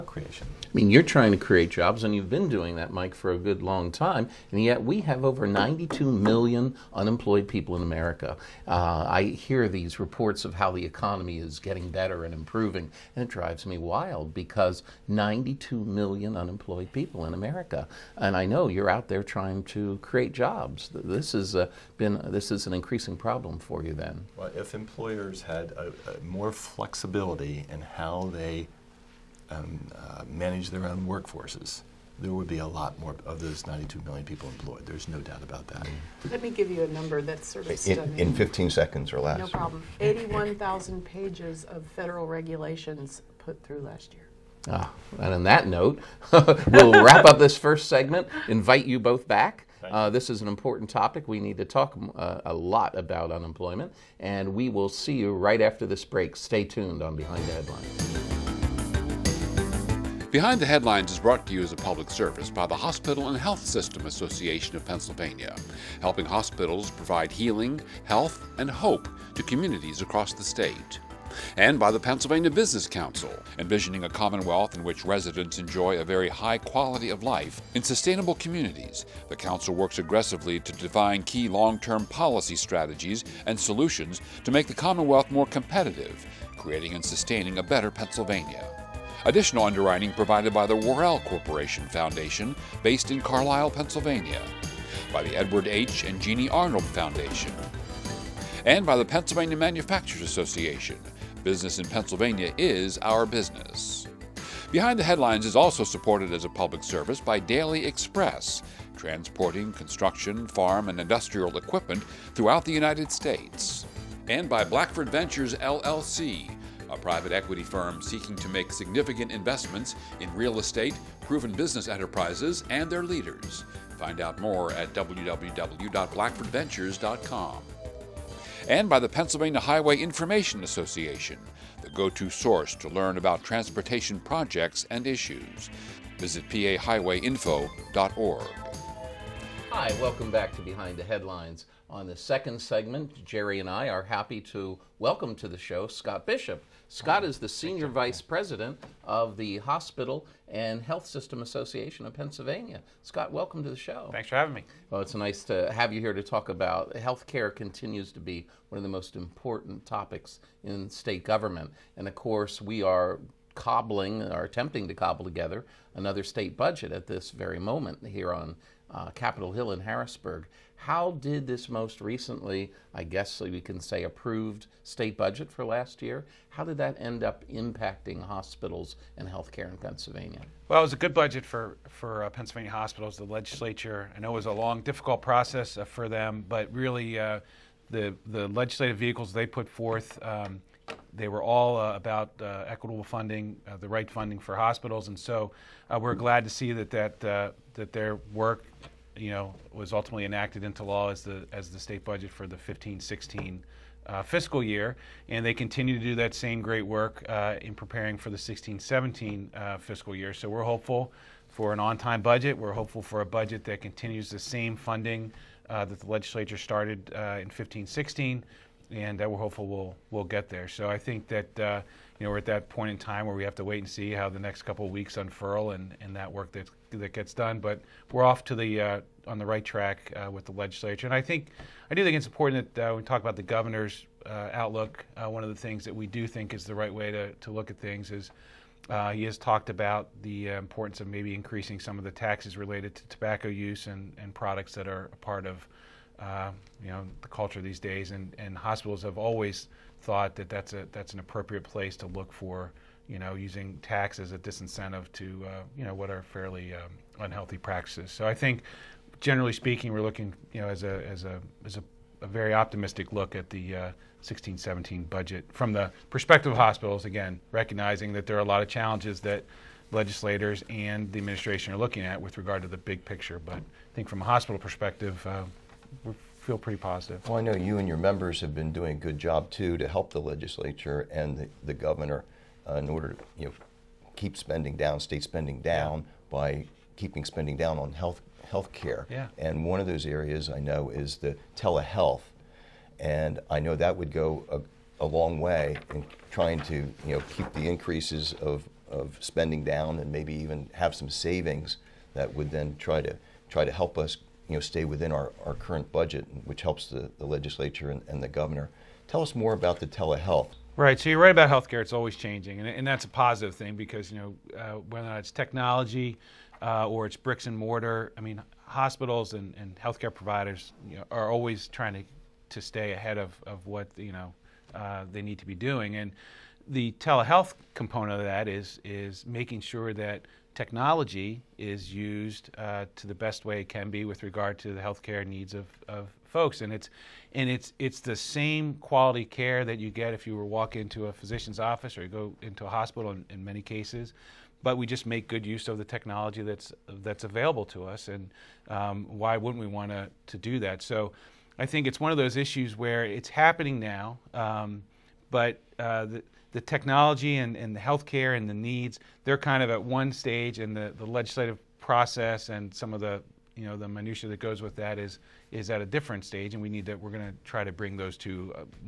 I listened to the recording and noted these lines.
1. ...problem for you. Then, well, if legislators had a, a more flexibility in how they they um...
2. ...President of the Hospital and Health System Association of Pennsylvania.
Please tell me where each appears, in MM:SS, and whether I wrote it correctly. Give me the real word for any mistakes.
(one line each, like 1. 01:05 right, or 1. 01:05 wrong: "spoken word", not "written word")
1. 00:23 wrong: "employers", not "legislators"
2. 02:28 right.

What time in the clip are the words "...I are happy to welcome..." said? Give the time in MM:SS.
02:23.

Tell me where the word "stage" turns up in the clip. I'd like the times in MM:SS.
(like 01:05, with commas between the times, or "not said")
06:00, 06:06.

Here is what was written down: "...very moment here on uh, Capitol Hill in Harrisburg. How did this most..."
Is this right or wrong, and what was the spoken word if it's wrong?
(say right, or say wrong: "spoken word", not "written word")
right.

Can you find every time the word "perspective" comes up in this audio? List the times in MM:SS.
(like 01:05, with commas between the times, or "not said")
04:26, 04:34.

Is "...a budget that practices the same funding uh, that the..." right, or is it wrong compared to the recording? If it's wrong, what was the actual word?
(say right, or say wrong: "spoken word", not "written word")
wrong: "continues", not "practices".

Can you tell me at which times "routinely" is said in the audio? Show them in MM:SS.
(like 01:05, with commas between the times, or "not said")
not said.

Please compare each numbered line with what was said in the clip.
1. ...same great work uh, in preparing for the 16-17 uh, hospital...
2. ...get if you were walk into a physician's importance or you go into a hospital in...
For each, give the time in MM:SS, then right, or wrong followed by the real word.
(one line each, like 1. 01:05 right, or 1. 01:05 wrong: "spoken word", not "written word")
1. 03:26 wrong: "fiscal", not "hospital"
2. 05:39 wrong: "office", not "importance".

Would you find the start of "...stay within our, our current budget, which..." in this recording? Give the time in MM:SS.
05:04.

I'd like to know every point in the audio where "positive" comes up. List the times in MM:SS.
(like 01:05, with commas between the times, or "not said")
04:36, 05:13.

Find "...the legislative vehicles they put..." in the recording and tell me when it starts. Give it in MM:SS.
03:08.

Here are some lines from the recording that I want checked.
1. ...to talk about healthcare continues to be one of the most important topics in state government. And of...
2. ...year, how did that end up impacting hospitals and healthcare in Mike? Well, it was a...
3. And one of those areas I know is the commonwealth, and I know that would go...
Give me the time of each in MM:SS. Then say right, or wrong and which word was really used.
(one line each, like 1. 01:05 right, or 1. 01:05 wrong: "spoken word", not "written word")
1. 02:36 right
2. 02:56 wrong: "Pennsylvania", not "Mike"
3. 04:49 wrong: "telehealth", not "commonwealth".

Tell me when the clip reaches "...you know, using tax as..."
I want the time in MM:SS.
04:13.